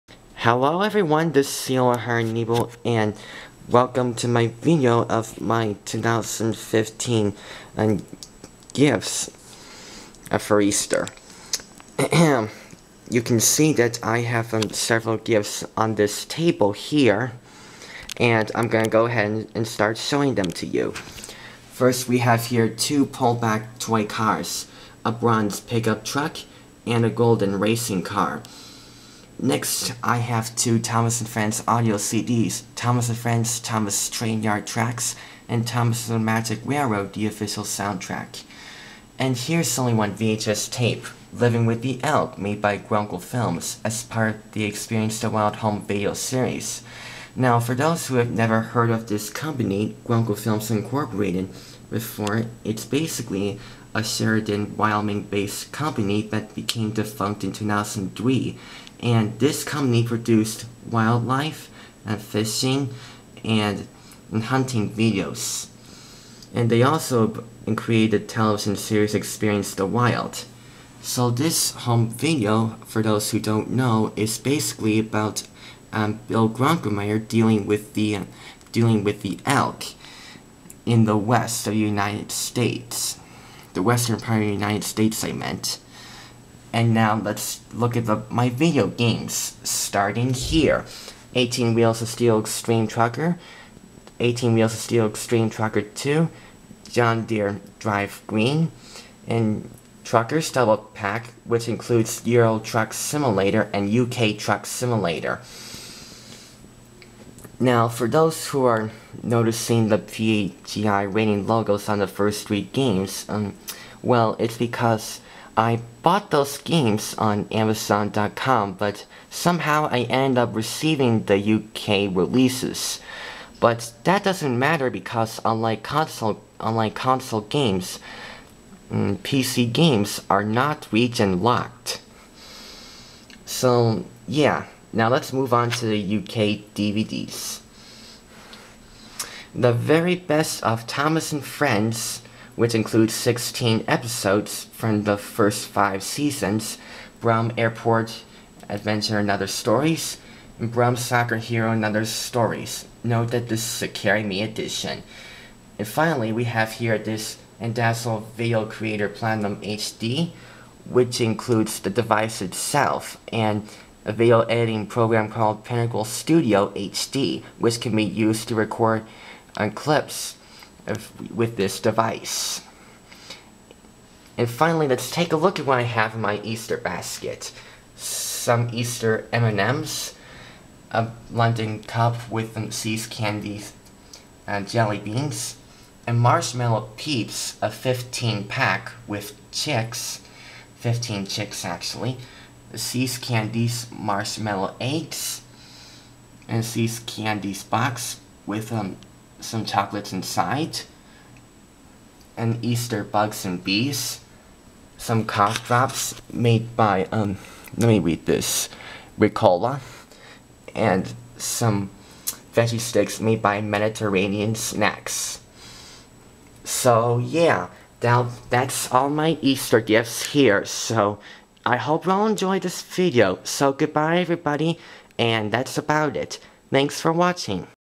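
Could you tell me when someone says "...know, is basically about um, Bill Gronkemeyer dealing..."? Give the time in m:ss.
1:13.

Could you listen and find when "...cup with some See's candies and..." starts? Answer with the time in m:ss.
3:01.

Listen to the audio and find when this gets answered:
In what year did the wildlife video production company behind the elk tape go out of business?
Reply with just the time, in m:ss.
0:57.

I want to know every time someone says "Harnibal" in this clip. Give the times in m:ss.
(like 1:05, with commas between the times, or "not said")
0:01.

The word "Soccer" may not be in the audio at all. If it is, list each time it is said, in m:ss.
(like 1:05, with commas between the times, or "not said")
2:30.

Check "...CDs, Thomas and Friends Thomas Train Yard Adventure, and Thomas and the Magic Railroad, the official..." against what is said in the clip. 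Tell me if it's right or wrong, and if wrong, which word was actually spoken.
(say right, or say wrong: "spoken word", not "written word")
wrong: "Tracks", not "Adventure".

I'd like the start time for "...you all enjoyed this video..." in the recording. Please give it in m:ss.
3:42.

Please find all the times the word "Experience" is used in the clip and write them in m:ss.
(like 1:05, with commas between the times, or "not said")
0:44, 1:09.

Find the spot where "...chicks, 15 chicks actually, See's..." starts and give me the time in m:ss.
3:09.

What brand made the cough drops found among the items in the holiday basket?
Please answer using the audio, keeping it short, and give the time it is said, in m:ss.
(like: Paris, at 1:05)
Ricola, at 3:29.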